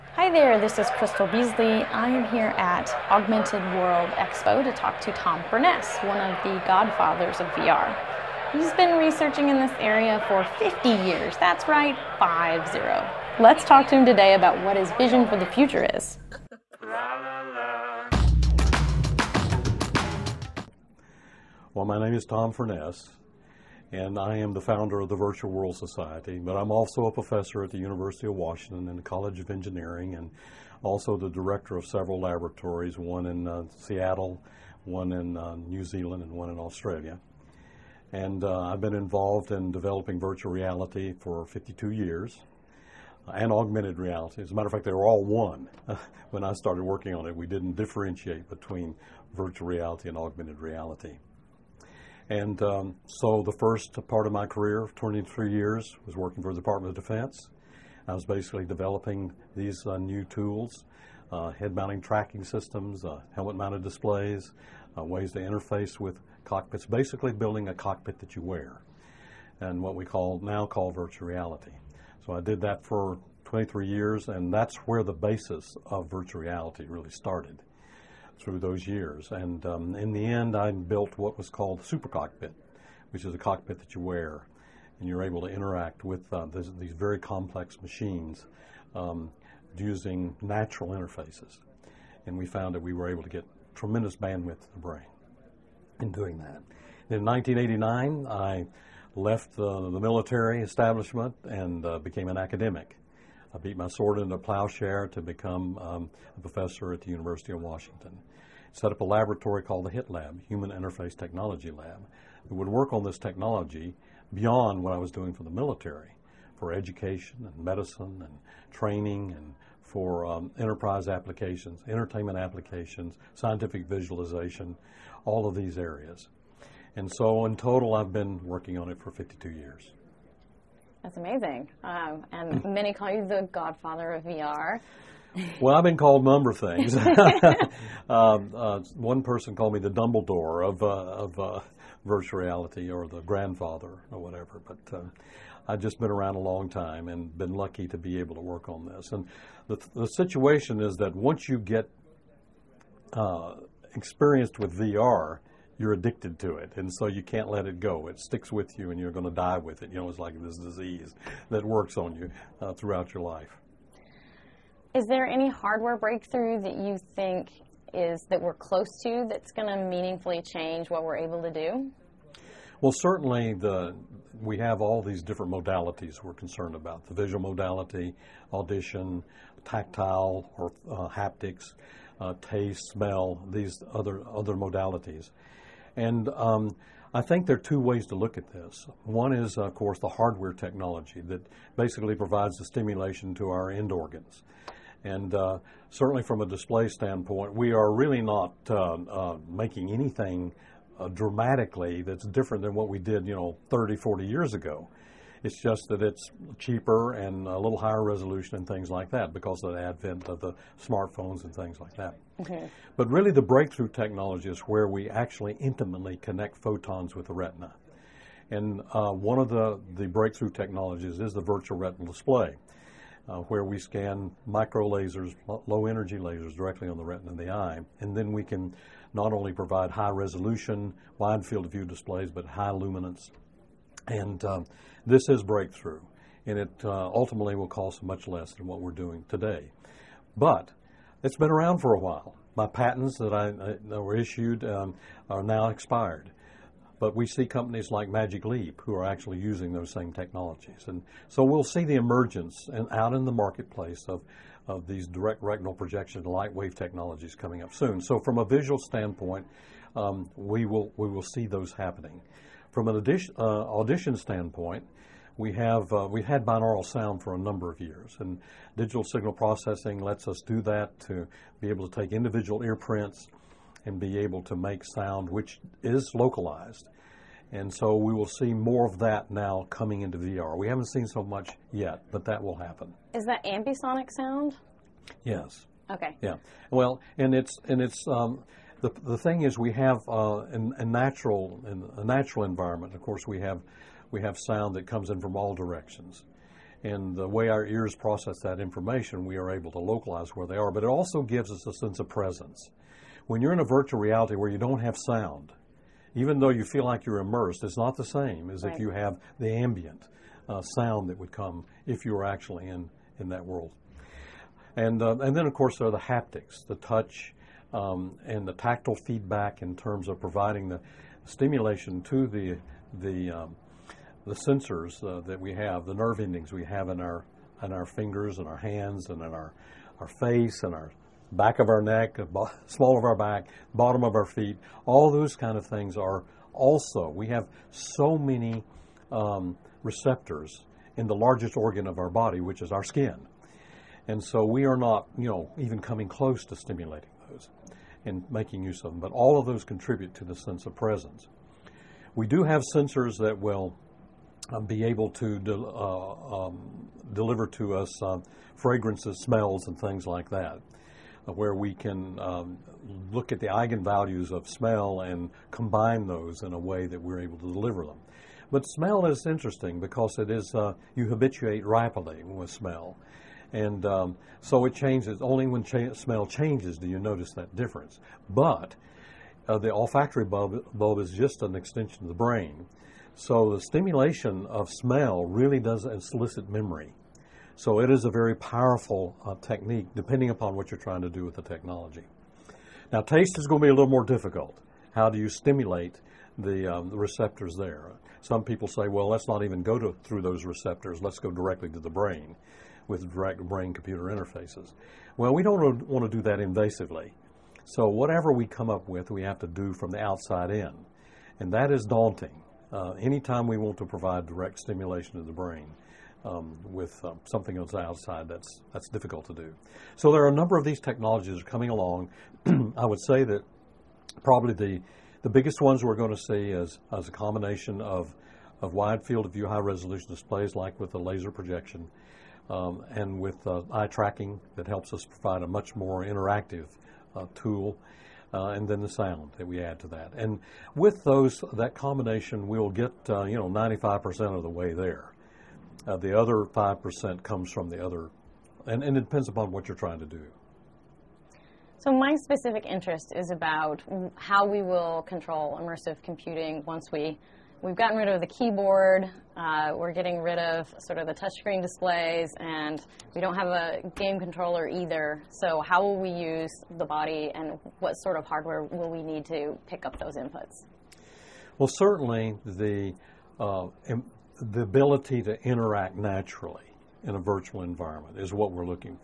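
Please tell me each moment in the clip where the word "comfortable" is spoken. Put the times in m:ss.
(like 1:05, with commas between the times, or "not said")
not said.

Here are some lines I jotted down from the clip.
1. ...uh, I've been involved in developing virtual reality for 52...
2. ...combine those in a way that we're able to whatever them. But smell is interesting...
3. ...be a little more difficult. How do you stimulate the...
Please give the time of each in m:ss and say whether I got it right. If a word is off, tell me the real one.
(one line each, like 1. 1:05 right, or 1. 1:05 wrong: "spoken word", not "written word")
1. 0:38 right
2. 6:05 wrong: "deliver", not "whatever"
3. 6:33 right.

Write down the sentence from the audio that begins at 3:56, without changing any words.
And it uh, ultimately will cost much less than what we're doing today.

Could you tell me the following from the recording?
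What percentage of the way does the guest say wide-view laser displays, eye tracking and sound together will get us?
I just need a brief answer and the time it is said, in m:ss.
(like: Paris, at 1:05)
95%, at 7:23.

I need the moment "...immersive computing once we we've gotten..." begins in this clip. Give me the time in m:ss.
7:35.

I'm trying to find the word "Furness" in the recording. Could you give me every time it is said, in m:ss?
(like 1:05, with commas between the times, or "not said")
0:05, 0:22.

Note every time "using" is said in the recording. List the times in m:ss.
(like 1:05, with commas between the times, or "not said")
1:29, 4:09.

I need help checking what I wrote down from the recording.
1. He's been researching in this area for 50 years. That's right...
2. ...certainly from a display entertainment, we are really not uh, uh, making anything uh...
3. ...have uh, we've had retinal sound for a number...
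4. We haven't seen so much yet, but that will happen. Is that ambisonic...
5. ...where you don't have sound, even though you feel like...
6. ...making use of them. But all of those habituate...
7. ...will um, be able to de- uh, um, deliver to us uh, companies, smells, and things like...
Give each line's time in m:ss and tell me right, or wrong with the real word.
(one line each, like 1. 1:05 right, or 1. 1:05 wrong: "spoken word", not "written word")
1. 0:08 right
2. 3:15 wrong: "standpoint", not "entertainment"
3. 4:25 wrong: "binaural", not "retinal"
4. 4:40 right
5. 5:04 right
6. 5:48 wrong: "contribute", not "habituate"
7. 5:53 wrong: "fragrances", not "companies".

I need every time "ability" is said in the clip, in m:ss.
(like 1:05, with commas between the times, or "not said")
7:54.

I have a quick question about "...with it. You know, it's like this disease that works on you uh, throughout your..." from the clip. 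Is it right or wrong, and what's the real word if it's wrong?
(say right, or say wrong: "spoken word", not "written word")
right.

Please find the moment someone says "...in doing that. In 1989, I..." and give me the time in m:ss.
1:35.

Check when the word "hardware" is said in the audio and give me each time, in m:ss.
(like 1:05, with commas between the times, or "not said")
2:45, 3:10, 7:48.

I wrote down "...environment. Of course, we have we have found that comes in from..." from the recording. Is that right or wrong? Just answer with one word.
wrong.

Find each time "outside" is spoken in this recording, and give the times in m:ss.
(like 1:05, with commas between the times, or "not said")
6:49, 6:57.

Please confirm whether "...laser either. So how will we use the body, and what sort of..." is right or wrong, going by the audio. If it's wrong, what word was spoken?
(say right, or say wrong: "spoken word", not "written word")
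wrong: "controller", not "laser".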